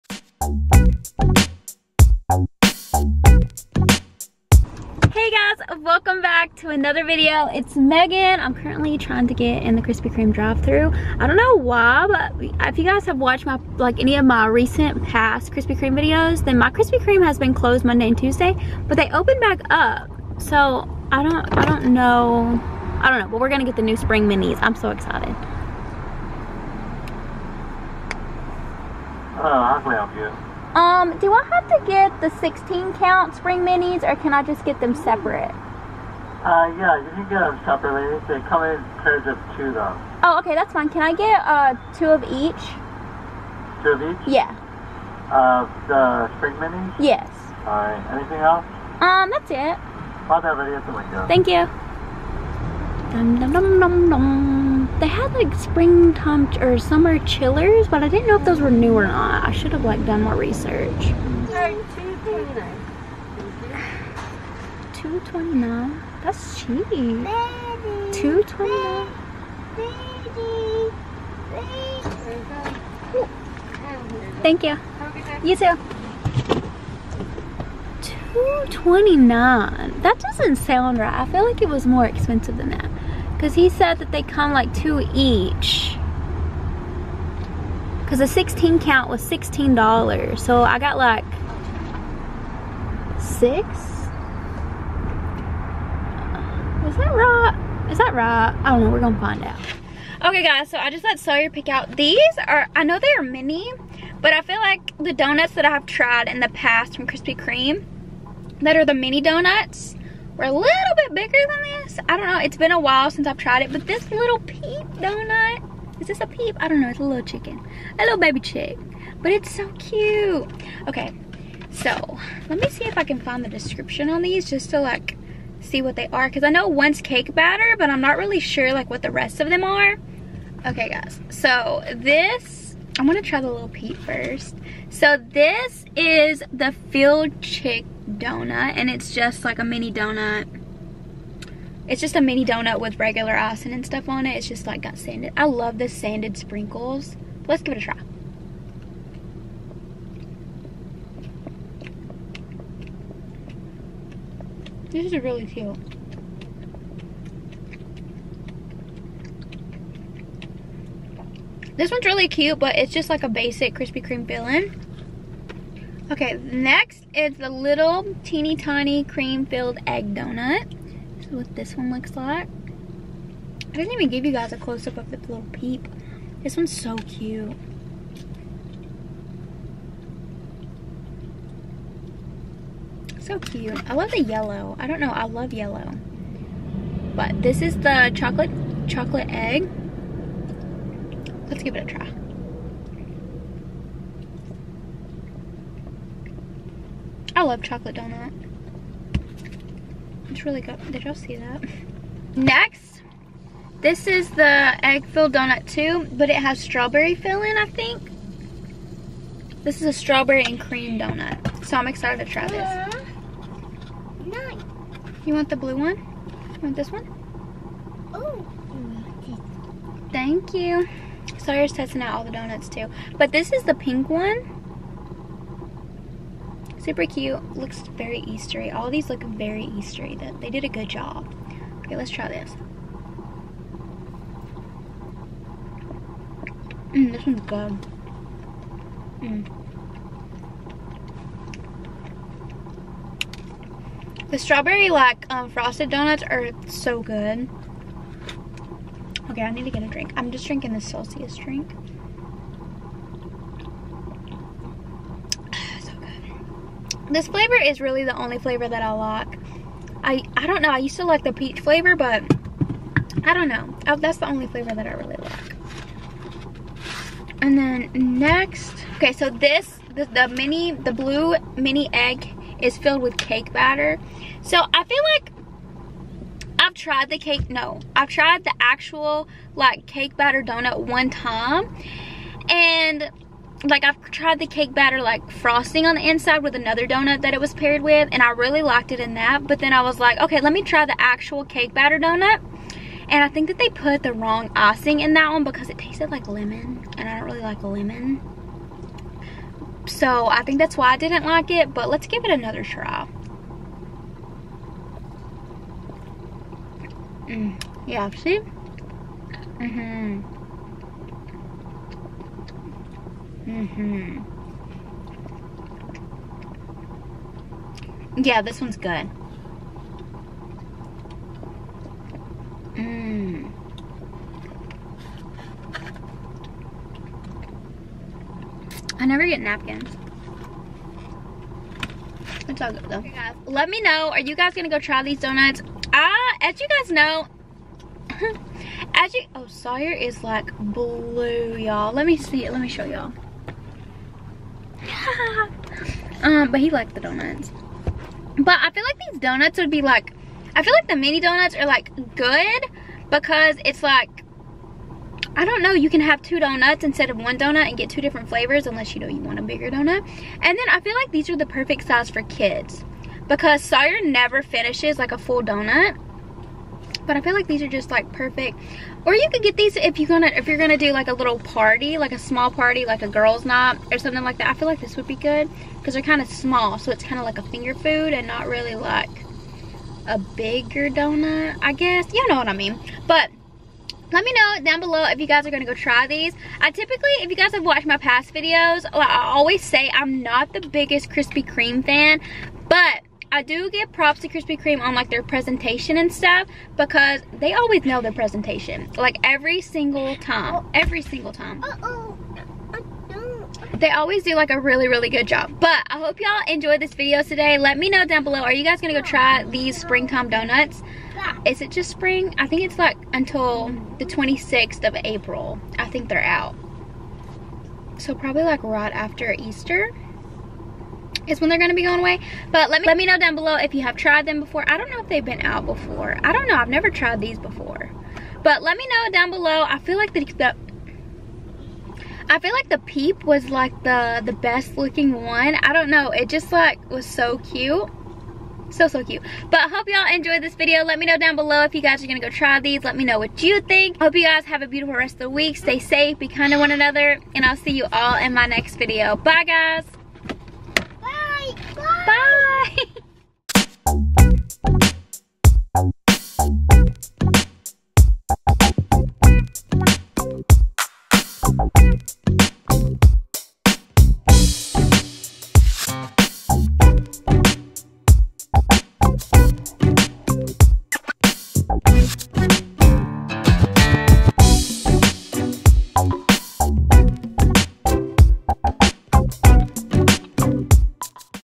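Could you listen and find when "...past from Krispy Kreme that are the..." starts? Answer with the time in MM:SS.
01:46.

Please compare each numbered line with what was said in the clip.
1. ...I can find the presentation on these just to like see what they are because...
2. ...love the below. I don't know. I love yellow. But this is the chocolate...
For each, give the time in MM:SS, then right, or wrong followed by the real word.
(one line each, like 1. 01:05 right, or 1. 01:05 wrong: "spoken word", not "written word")
1. 02:02 wrong: "description", not "presentation"
2. 03:03 wrong: "yellow", not "below".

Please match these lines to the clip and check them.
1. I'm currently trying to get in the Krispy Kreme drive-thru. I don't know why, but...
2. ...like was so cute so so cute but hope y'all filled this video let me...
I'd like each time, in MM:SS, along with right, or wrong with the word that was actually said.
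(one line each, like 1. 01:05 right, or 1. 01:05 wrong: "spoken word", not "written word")
1. 00:08 right
2. 07:16 wrong: "enjoyed", not "filled".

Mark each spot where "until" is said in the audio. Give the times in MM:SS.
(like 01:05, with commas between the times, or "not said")
06:53.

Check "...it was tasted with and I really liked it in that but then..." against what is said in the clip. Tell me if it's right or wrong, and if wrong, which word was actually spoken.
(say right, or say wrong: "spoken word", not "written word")
wrong: "paired", not "tasted".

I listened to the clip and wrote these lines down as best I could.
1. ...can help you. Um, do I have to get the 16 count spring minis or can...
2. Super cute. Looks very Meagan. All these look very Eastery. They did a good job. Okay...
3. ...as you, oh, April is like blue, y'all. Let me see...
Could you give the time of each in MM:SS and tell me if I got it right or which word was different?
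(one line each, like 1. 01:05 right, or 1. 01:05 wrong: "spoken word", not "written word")
1. 00:29 right
2. 03:46 wrong: "Eastery", not "Meagan"
3. 05:38 wrong: "Sawyer", not "April".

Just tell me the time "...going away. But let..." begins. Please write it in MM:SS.
07:01.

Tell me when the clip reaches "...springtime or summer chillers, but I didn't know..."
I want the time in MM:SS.
00:55.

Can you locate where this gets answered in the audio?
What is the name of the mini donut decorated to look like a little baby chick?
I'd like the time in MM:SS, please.
02:16.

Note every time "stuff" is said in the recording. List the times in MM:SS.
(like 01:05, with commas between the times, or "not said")
02:23, 06:36.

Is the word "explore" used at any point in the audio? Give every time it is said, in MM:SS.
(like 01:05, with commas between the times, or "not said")
not said.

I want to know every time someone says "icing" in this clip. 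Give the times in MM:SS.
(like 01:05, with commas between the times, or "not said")
02:23, 04:54.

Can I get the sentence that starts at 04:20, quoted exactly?
I used to like the peach flavor, but I don't know.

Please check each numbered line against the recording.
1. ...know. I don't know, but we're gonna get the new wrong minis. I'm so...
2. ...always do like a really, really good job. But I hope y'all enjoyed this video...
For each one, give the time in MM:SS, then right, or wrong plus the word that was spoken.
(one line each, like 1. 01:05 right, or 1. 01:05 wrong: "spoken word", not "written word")
1. 00:21 wrong: "spring", not "wrong"
2. 06:43 right.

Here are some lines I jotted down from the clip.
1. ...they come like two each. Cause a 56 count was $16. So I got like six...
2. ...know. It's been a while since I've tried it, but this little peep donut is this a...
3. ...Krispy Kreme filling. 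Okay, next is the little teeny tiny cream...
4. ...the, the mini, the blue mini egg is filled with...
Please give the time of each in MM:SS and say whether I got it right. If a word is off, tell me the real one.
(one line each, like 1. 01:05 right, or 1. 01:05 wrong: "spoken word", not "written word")
1. 01:24 wrong: "16", not "56"
2. 01:52 right
3. 02:43 right
4. 04:29 right.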